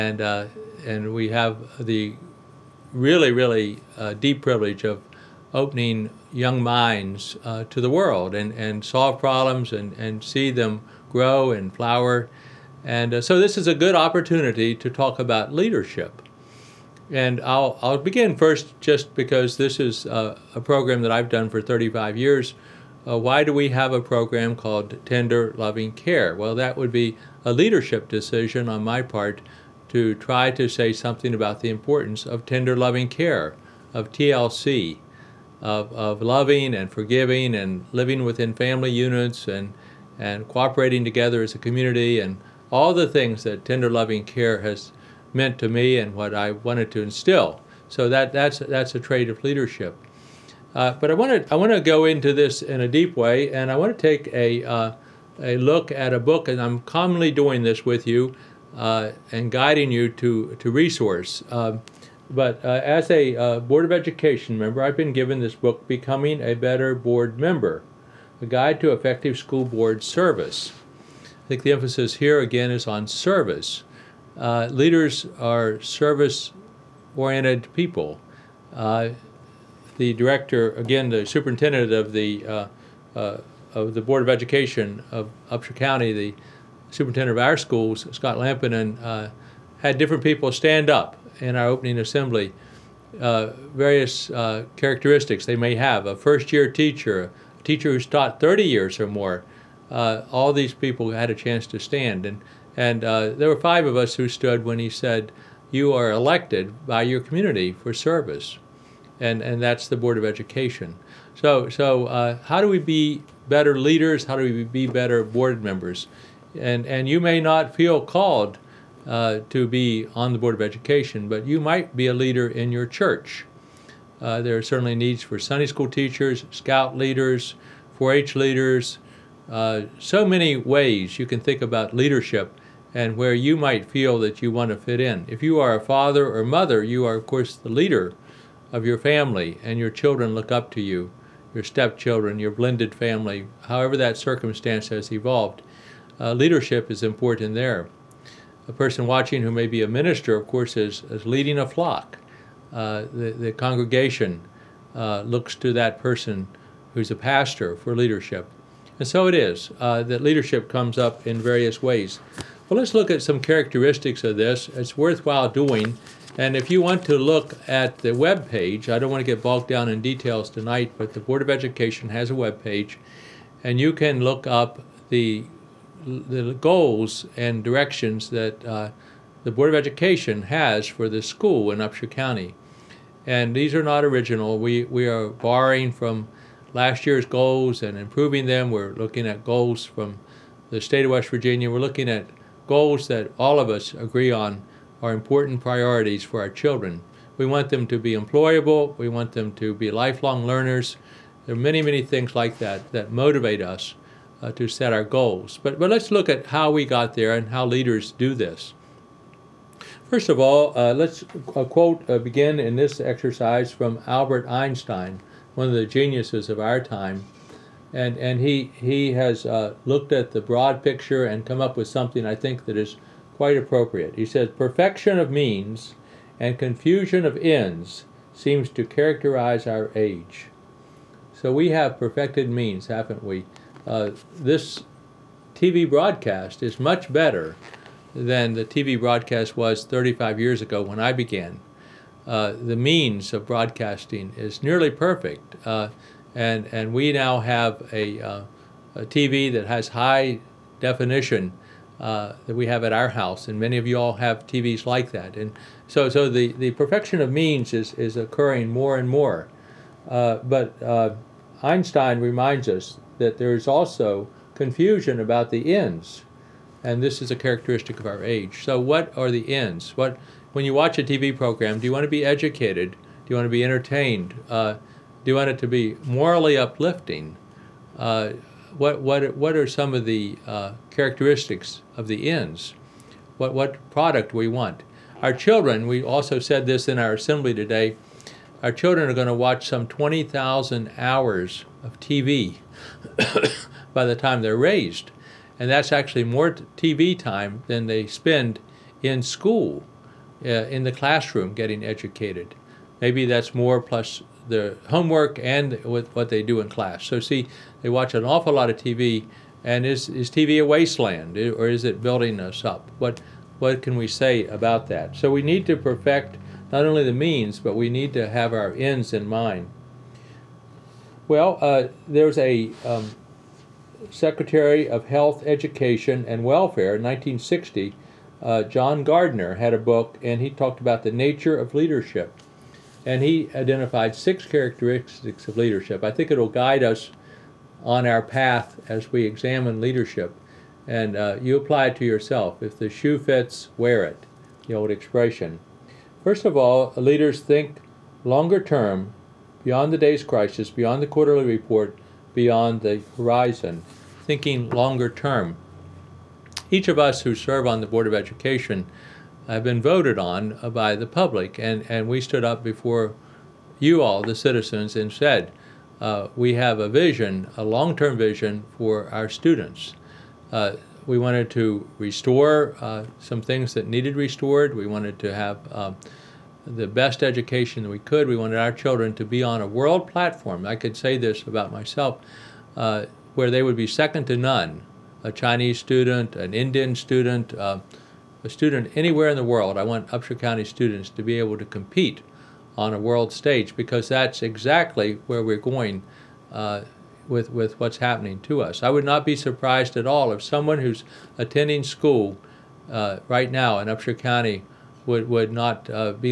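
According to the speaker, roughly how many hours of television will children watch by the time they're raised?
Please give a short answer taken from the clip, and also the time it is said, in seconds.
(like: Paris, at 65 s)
20,000, at 289 s.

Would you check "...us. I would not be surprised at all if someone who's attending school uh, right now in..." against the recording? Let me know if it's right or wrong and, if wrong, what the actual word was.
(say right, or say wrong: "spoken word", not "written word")
right.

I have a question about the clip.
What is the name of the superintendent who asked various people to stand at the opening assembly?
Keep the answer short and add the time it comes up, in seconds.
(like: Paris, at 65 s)
Scott Lampinen, at 88 s.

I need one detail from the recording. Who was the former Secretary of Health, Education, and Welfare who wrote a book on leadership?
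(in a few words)
John Gardner.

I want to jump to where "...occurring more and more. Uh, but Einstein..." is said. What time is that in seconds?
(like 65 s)
258 s.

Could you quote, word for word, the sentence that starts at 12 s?
And uh, so this is a good opportunity to talk about leadership.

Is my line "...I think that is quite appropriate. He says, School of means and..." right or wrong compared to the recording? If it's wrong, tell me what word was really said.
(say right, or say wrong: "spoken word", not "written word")
wrong: "Perfection", not "School".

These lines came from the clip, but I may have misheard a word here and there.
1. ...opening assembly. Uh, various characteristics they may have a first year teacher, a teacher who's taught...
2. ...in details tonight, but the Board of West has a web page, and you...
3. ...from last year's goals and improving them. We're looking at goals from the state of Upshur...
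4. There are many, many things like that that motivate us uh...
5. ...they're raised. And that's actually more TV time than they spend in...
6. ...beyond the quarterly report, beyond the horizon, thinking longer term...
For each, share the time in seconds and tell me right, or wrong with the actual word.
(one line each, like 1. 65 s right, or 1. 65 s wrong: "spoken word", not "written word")
1. 91 s right
2. 169 s wrong: "Education", not "West"
3. 185 s wrong: "West", not "Upshur"
4. 201 s right
5. 294 s right
6. 350 s right.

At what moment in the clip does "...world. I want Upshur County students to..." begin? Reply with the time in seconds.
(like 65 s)
389 s.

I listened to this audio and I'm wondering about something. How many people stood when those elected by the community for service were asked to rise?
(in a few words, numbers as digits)
5.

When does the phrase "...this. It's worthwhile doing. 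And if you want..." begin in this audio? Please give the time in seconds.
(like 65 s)
164 s.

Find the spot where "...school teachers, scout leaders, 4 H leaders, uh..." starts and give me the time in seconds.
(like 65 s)
125 s.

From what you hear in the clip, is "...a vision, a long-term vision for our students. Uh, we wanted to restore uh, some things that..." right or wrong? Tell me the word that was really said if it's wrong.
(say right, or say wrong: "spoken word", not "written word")
right.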